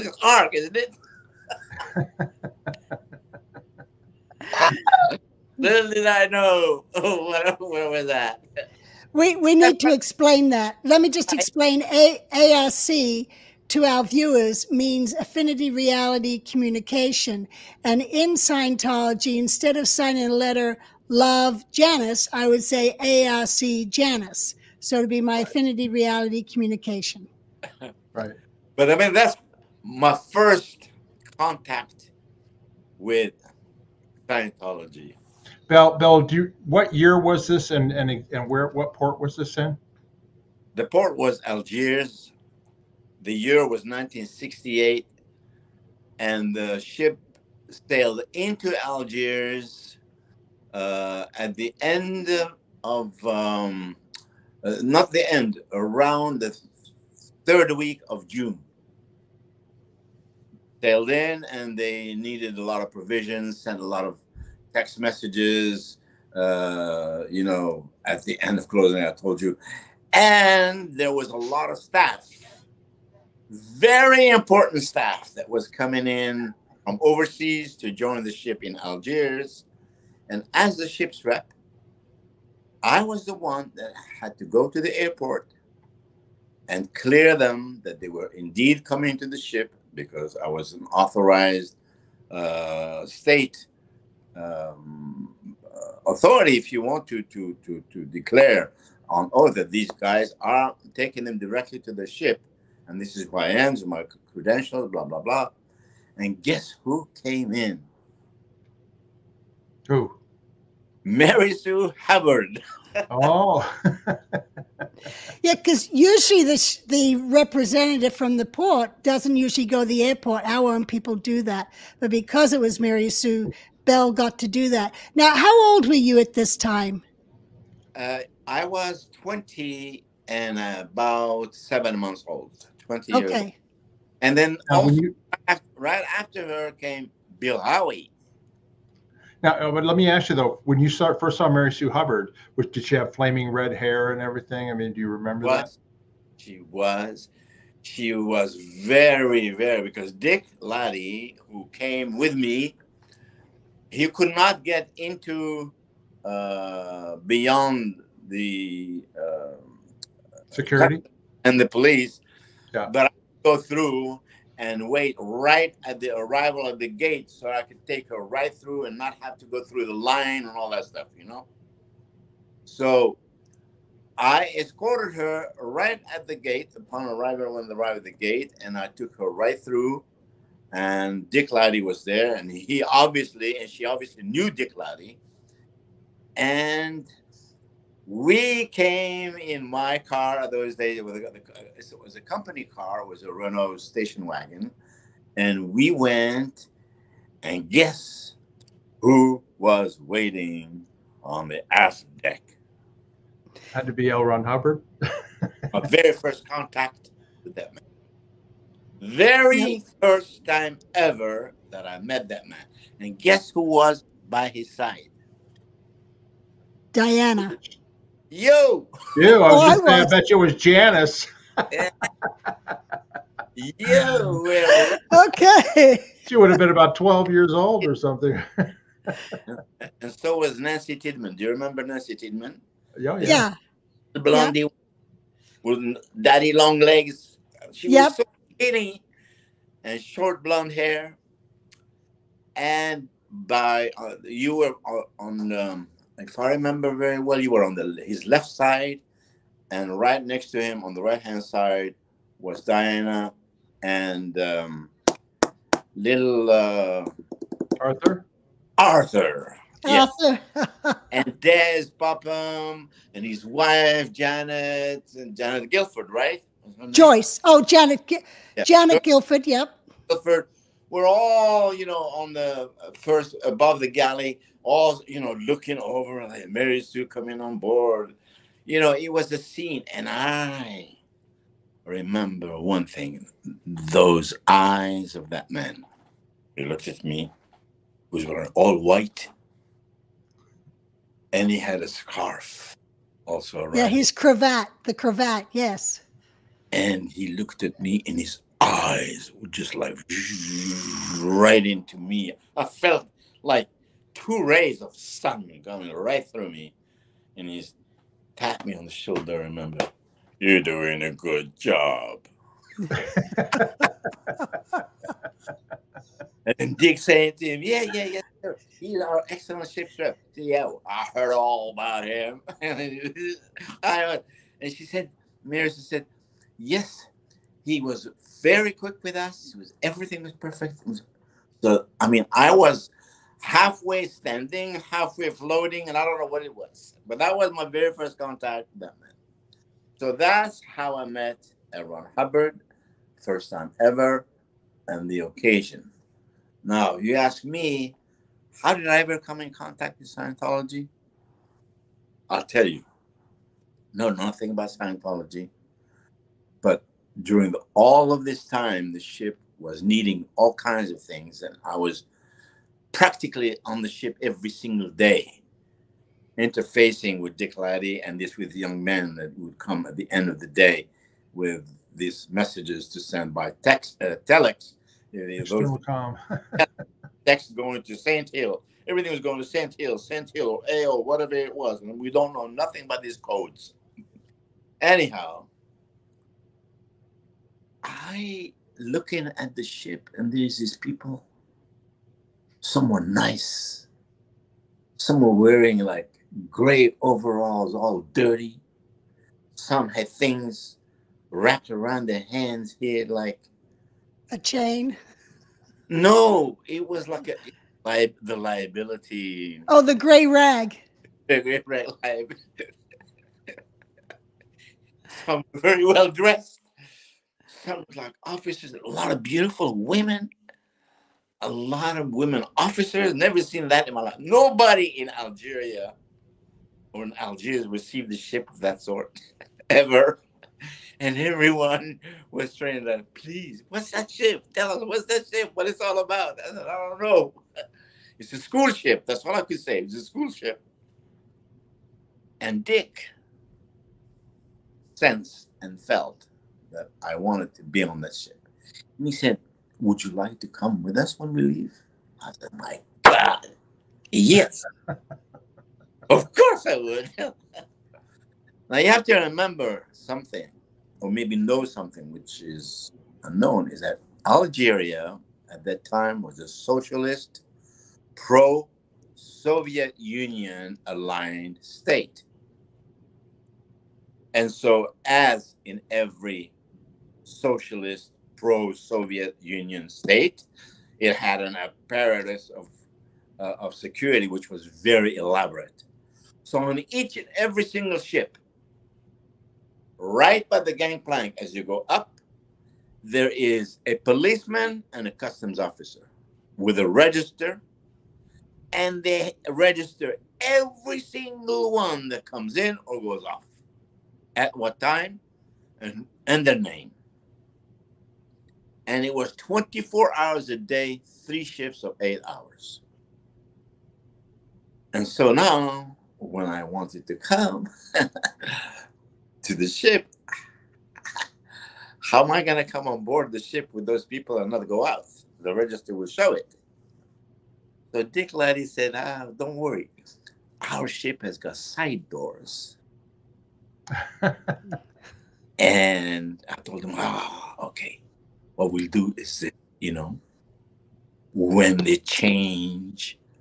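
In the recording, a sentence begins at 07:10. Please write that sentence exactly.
And everyone was trying to, please, what's that ship?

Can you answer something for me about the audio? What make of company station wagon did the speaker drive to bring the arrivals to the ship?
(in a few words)
Renault.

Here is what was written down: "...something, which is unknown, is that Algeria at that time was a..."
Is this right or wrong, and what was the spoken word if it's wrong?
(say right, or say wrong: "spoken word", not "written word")
right.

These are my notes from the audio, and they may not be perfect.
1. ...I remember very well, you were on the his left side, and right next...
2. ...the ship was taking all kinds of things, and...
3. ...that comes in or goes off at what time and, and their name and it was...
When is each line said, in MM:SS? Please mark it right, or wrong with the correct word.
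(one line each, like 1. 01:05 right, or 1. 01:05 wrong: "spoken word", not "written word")
1. 04:06 right
2. 05:58 wrong: "needing", not "taking"
3. 08:22 right.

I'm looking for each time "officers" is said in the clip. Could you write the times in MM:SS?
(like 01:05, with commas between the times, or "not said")
06:58, 07:02, 08:15.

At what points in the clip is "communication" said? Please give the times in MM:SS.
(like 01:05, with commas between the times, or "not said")
00:16, 00:26.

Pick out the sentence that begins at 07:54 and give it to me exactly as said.
And so, as in every socialist pro-Soviet Union state.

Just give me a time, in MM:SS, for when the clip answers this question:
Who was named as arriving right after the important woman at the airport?
02:17.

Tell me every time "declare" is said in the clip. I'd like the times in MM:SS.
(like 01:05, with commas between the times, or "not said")
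01:38.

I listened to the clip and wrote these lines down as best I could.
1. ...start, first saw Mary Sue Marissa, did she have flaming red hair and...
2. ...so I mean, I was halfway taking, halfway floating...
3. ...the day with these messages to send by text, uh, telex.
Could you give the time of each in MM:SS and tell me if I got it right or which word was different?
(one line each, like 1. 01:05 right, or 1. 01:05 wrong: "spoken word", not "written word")
1. 02:20 wrong: "Hubbard", not "Marissa"
2. 05:31 wrong: "standing", not "taking"
3. 06:10 right.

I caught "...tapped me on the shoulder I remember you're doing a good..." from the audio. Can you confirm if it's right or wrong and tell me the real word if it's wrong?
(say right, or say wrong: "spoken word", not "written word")
right.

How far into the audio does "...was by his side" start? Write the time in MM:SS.
03:33.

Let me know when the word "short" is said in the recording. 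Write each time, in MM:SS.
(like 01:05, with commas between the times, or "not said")
03:59.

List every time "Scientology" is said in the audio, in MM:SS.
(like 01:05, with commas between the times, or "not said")
00:18, 00:34, 05:50, 05:54.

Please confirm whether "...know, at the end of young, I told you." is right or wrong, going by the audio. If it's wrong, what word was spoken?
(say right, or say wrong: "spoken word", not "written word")
wrong: "closing", not "young".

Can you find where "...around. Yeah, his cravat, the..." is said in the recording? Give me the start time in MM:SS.
04:53.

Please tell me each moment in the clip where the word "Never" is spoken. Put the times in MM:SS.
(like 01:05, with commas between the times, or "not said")
07:03.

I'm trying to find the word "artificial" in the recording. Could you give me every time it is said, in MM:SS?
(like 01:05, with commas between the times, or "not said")
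not said.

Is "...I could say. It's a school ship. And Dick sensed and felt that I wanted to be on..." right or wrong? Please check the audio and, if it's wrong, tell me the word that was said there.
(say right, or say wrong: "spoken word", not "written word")
right.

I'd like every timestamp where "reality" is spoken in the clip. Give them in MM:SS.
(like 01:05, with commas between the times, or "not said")
00:15, 00:25.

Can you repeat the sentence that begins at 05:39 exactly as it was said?
So that's how I met Ron Hubbard, first time ever, and the occasion.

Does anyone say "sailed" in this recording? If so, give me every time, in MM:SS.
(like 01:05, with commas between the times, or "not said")
00:47, 01:00.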